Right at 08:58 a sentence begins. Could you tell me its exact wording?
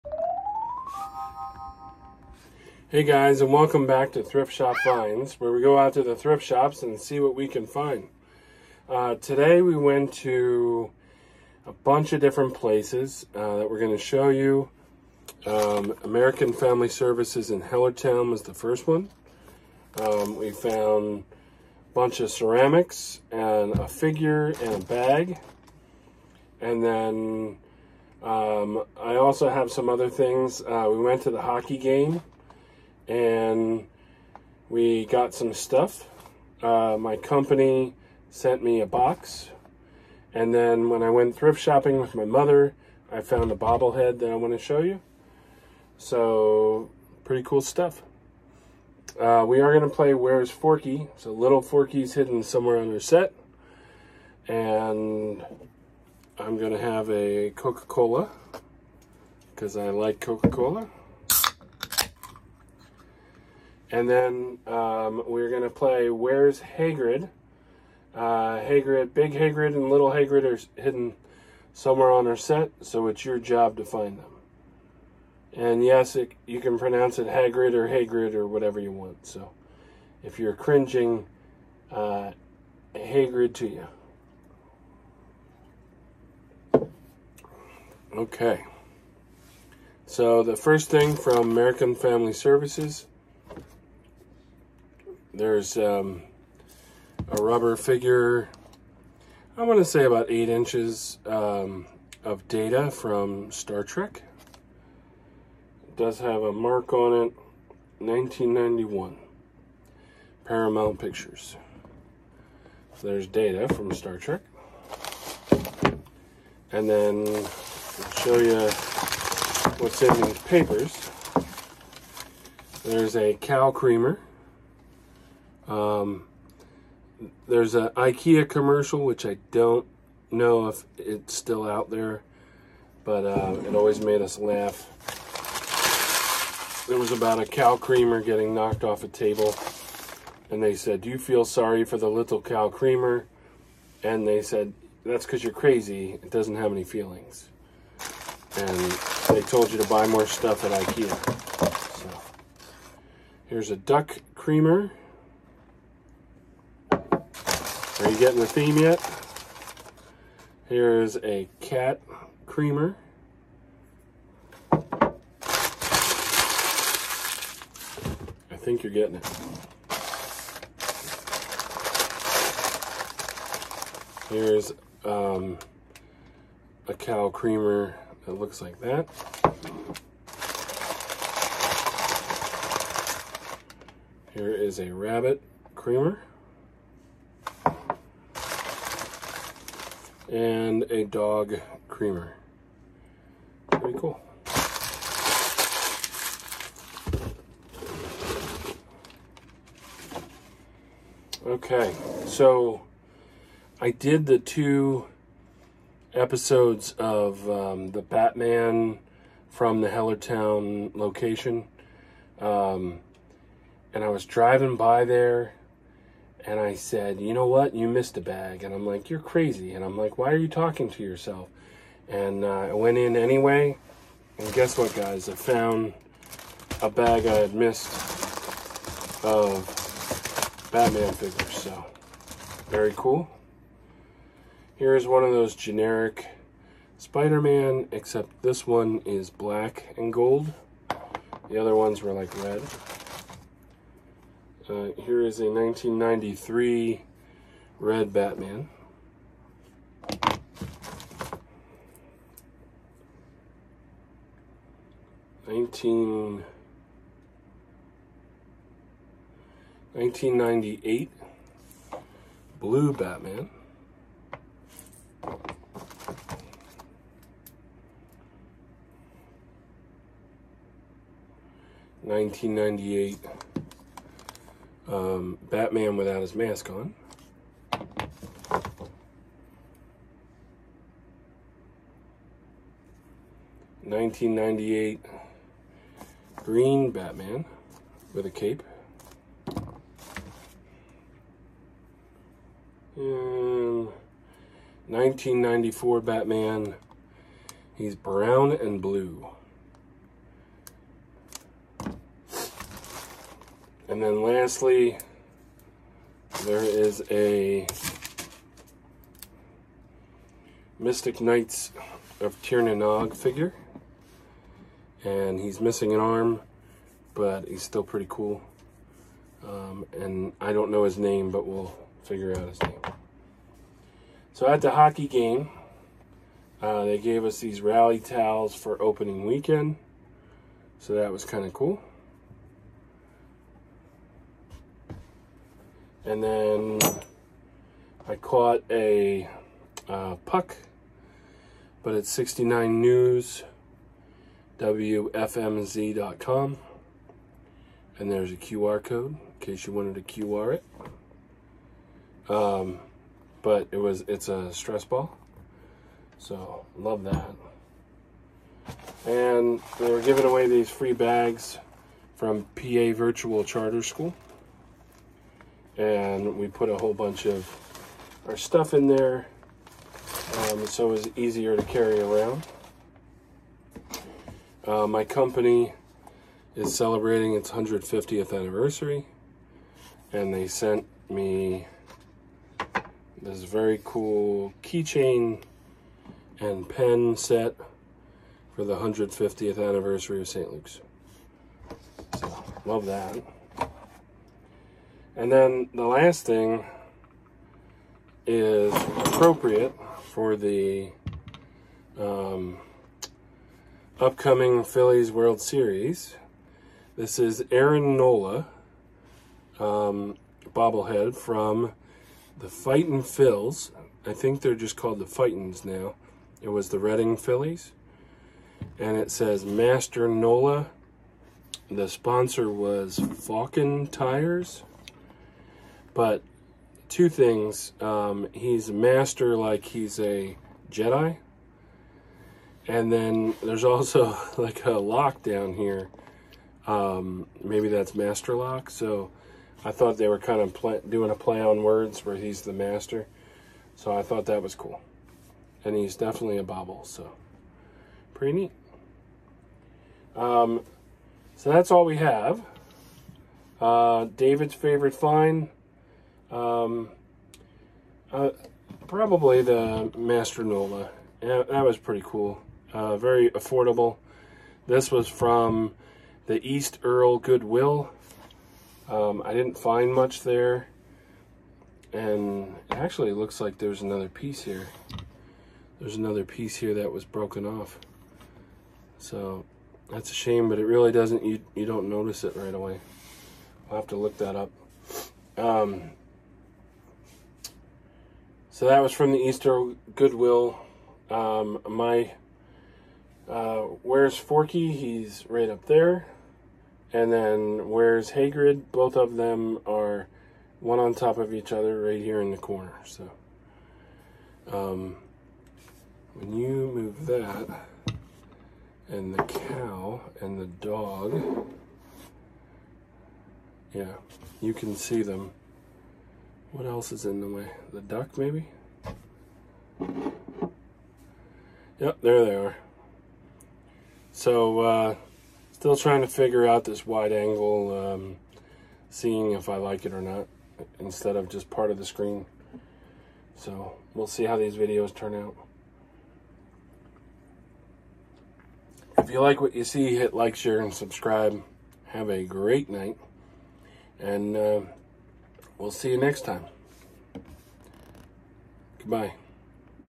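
If you like what you see, hit like, share, and subscribe.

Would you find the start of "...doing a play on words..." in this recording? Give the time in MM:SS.
07:20.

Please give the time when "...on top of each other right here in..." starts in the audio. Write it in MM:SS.
08:20.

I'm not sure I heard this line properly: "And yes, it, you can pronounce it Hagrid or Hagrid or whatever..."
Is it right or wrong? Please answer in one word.
right.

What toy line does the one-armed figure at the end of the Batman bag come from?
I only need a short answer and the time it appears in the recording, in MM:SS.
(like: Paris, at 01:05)
Mystic Knights of Tirnanog, at 05:10.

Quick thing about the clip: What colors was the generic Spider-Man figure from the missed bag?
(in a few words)
Black and gold.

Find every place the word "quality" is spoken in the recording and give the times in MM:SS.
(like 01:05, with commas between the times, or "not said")
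not said.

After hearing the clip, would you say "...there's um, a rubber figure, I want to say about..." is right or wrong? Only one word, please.
right.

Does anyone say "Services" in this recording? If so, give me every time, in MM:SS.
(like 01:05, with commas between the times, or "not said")
00:16, 01:32.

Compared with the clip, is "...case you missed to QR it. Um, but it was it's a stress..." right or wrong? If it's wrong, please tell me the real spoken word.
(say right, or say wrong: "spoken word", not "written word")
wrong: "wanted", not "missed".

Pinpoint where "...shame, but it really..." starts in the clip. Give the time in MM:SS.
08:00.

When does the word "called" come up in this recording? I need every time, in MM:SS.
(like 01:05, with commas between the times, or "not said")
06:54.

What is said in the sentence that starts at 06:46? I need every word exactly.
This is Aaron Nola, um, bobblehead from the Fightin' Phils.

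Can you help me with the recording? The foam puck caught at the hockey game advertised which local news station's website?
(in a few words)
WFMZ.com.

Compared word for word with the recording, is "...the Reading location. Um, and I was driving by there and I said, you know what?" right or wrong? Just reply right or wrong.
wrong.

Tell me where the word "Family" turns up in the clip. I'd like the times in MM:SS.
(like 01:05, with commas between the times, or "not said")
00:16, 01:31.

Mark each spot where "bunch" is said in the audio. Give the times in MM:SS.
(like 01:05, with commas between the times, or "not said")
00:11, 00:21, 06:06.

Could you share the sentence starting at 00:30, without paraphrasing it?
Uh, we went to the hockey game and we got some stuff.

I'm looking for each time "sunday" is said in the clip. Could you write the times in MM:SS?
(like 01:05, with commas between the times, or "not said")
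not said.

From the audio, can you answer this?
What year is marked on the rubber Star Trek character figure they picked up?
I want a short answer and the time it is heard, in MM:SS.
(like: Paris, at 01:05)
1991, at 01:47.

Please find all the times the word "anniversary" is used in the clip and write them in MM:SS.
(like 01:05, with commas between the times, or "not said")
06:18, 06:29.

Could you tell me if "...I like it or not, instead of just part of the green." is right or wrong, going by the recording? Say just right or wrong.
wrong.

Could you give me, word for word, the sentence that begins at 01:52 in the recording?
So there's data from Star Trek.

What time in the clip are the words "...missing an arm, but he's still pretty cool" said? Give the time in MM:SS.
05:15.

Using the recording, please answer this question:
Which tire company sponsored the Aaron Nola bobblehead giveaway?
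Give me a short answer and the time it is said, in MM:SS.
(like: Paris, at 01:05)
Falken Tires, at 07:02.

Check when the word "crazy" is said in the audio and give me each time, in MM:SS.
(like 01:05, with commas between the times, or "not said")
02:25, 03:39.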